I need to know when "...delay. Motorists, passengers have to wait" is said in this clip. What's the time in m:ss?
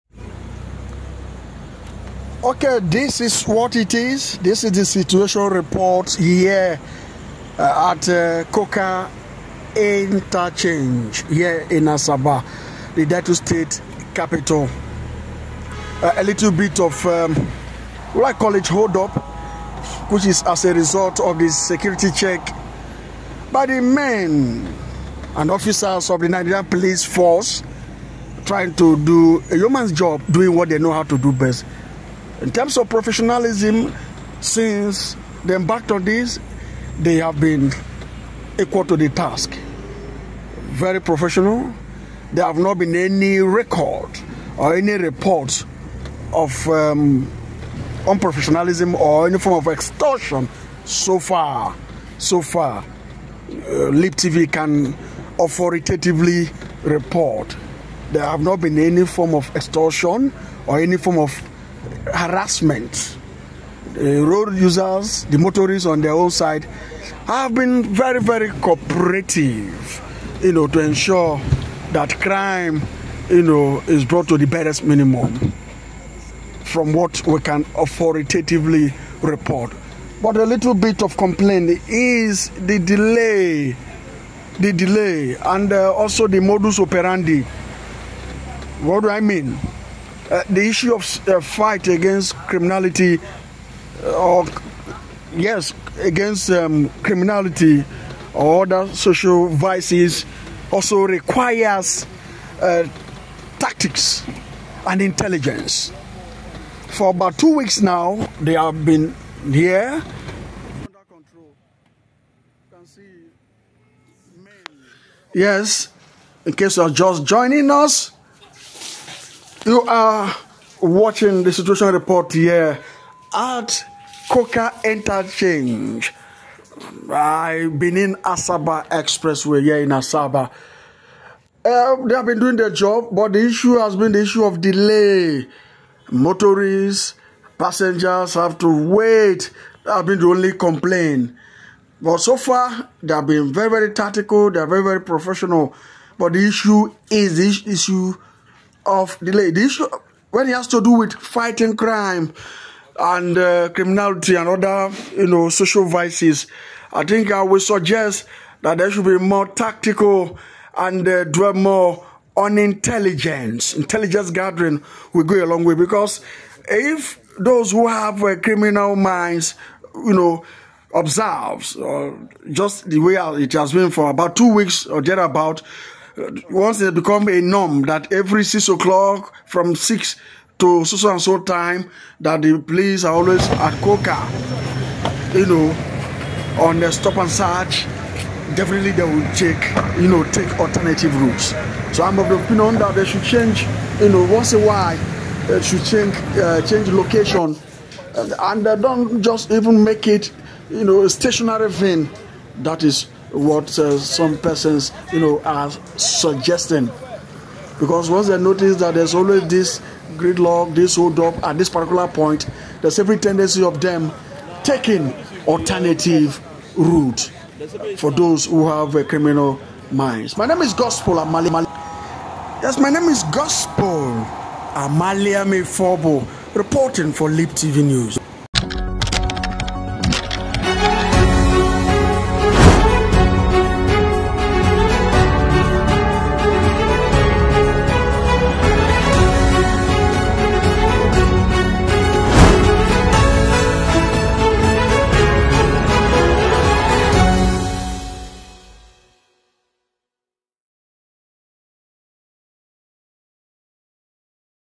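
2:14.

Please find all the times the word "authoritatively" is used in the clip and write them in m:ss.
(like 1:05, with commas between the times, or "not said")
0:55, 1:17.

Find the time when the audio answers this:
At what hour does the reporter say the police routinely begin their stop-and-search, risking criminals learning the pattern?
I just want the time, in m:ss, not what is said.
2:58.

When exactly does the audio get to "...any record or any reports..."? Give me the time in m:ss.
0:42.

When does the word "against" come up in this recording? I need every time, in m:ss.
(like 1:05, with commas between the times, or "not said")
1:31, 1:35.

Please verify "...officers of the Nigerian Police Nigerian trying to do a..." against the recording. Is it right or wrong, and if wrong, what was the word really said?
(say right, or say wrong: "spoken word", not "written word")
wrong: "Force", not "Nigerian".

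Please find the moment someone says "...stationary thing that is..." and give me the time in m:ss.
3:21.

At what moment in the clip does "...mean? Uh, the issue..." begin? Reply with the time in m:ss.
1:29.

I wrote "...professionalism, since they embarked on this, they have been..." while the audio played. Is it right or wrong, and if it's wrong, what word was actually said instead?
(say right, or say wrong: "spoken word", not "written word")
right.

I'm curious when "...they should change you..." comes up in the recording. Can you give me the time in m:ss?
3:12.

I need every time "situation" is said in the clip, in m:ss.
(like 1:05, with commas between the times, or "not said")
0:04, 2:01.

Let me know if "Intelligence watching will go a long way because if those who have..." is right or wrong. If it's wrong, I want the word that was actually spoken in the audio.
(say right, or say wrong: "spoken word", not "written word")
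wrong: "gathering", not "watching".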